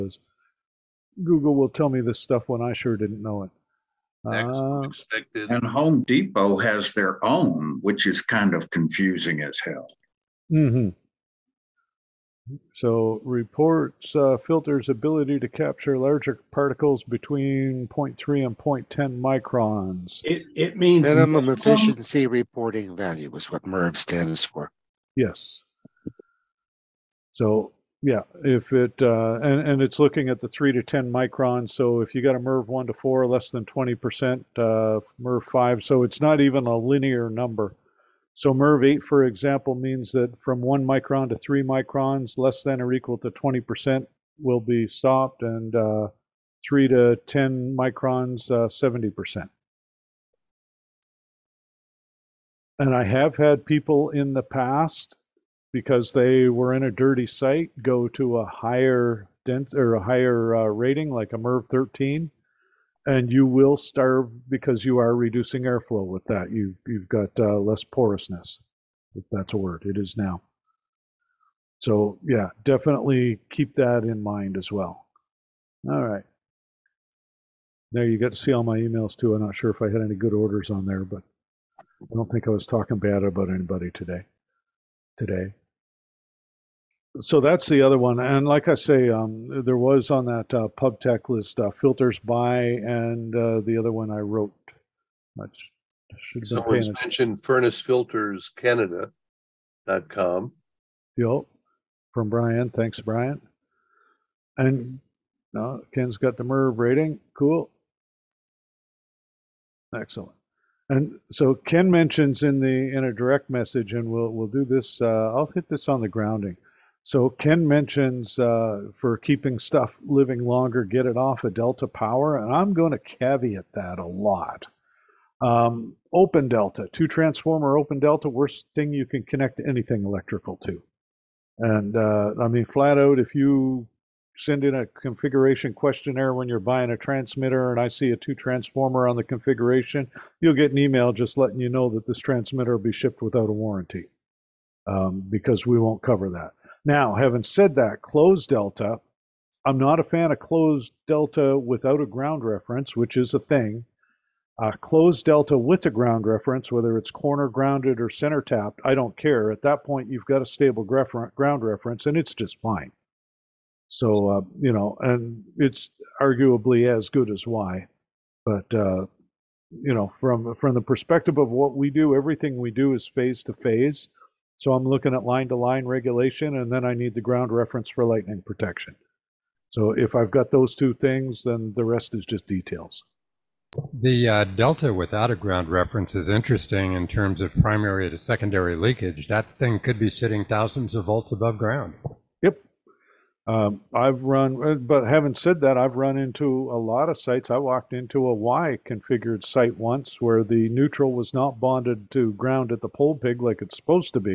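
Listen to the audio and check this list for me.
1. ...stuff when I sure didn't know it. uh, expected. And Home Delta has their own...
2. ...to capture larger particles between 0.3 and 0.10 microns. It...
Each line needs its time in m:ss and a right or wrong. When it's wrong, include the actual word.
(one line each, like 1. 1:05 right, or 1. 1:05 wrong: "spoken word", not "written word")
1. 0:02 wrong: "Depot", not "Delta"
2. 0:15 right.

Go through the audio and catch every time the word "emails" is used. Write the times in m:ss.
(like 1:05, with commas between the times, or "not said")
1:18, 2:20.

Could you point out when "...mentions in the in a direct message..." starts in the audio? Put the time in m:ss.
1:51.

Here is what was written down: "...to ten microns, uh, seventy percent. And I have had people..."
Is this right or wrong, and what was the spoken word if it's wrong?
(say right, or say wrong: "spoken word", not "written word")
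right.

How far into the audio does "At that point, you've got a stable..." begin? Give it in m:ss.
2:39.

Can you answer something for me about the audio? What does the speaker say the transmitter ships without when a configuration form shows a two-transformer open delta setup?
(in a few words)
a warranty.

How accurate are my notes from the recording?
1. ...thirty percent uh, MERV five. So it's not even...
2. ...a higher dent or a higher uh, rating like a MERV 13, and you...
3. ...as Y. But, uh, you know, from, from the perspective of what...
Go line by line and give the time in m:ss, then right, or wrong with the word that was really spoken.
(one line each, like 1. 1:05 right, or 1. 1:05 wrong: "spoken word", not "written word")
1. 0:33 wrong: "twenty", not "thirty"
2. 0:58 right
3. 2:47 right.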